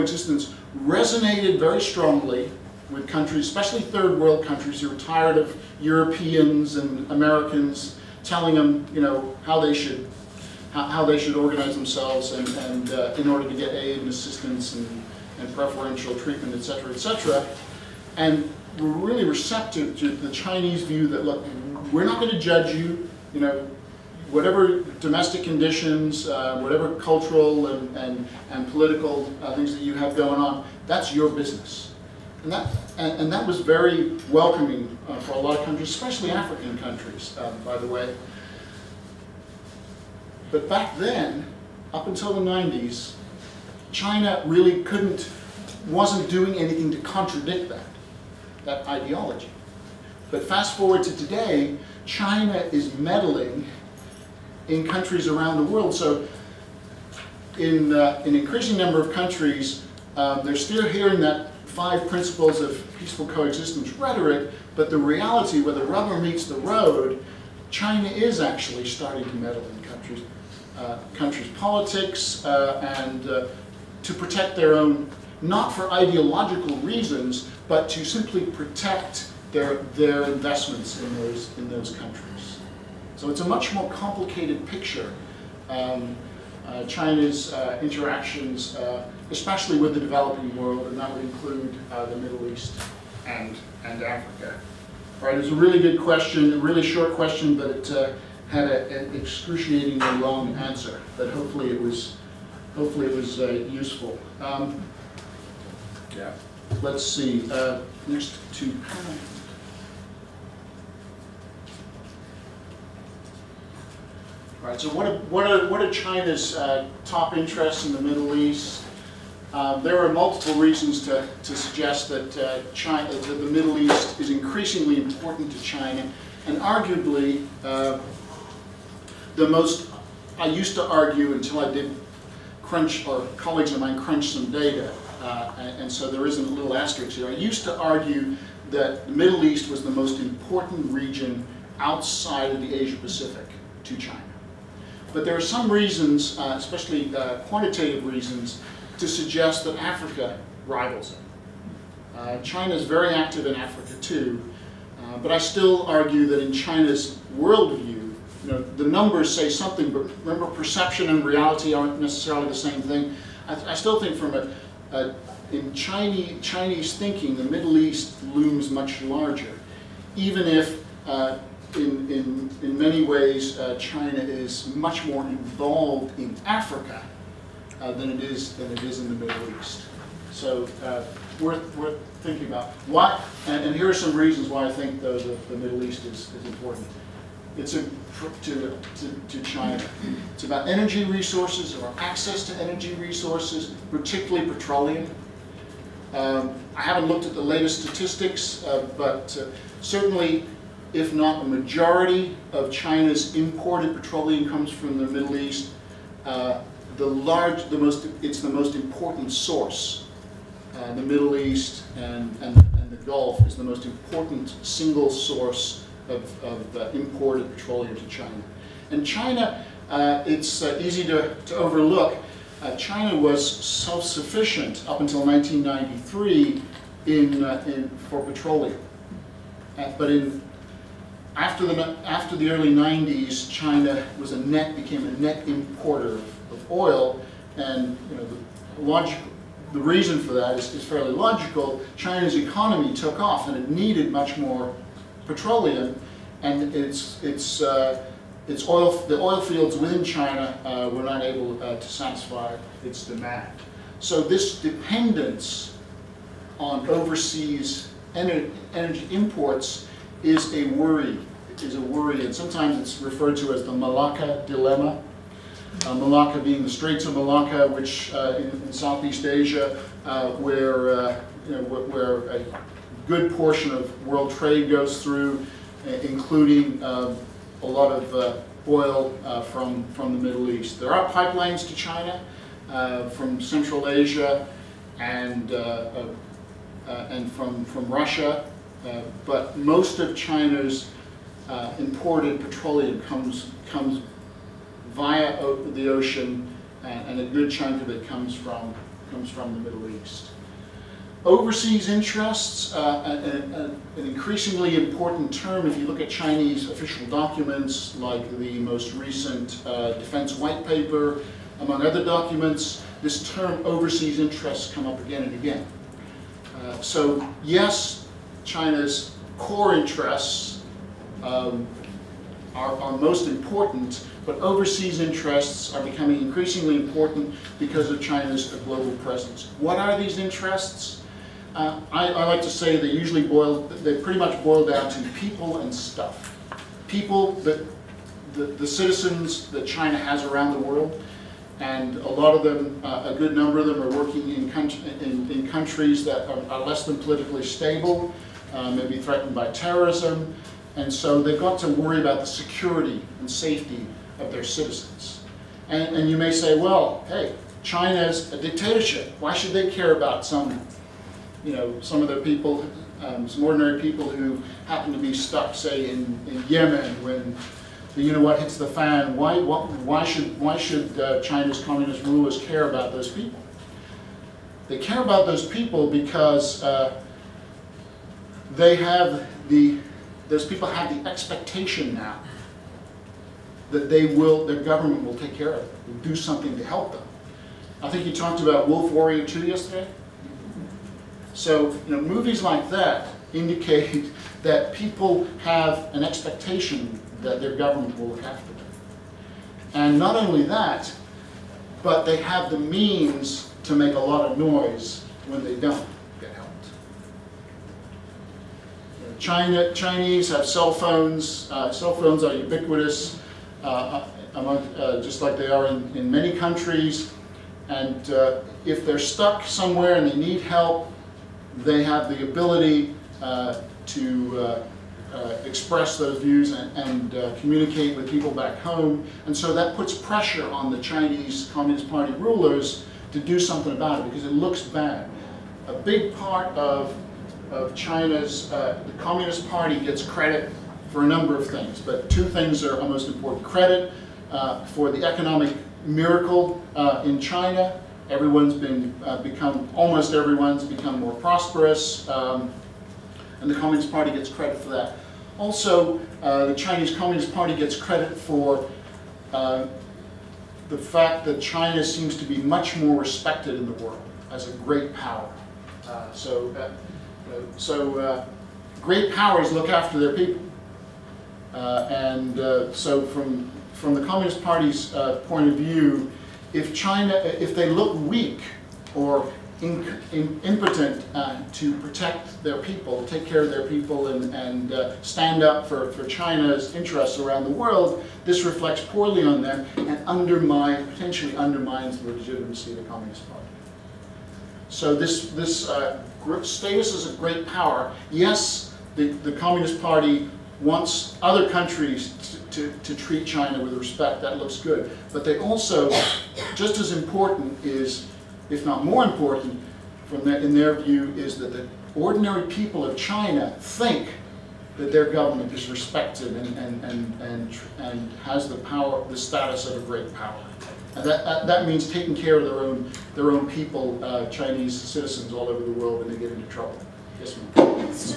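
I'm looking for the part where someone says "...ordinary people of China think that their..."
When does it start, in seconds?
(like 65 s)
511 s.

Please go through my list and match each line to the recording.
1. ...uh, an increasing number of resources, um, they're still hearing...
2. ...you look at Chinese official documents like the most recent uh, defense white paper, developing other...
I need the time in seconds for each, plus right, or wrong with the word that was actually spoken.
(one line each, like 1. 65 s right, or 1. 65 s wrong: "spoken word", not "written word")
1. 57 s wrong: "countries", not "resources"
2. 305 s wrong: "among", not "developing".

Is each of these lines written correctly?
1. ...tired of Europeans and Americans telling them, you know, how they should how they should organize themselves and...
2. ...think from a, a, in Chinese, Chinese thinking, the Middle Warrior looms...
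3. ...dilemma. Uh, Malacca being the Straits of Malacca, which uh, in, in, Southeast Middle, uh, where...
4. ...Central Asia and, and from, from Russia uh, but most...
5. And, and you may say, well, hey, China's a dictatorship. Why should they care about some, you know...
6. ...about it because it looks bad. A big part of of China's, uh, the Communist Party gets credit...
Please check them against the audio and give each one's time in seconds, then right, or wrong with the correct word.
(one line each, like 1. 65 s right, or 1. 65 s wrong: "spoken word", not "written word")
1. 4 s right
2. 164 s wrong: "East", not "Warrior"
3. 264 s wrong: "Asia", not "Middle"
4. 283 s right
5. 355 s right
6. 433 s right.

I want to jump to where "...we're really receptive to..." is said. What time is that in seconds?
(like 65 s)
18 s.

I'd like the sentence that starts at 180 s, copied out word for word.
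So uh, worth worth thinking about.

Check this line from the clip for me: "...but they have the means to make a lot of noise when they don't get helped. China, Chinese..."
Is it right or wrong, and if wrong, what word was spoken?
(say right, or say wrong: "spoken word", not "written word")
right.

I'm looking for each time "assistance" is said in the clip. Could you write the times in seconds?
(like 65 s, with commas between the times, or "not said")
14 s.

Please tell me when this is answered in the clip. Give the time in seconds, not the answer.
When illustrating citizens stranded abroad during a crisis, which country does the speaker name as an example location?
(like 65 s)
366 s.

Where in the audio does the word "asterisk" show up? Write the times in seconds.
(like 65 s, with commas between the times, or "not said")
136 s.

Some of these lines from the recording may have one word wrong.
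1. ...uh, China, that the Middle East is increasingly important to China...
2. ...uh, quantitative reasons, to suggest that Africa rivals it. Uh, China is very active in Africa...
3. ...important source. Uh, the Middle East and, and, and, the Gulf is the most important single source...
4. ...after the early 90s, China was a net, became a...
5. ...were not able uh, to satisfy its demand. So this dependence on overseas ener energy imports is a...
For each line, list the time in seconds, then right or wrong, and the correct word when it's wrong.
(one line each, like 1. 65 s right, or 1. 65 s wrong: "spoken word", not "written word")
1. 122 s right
2. 147 s right
3. 208 s right
4. 232 s right
5. 250 s right.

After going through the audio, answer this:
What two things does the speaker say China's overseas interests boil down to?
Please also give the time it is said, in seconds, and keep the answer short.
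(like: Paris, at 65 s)
People and stuff, at 335 s.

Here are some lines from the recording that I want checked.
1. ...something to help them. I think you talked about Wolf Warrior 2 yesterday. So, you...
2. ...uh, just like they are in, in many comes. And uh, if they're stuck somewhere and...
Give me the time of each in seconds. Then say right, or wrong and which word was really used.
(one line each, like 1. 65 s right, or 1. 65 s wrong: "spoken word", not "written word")
1. 386 s right
2. 414 s wrong: "countries", not "comes".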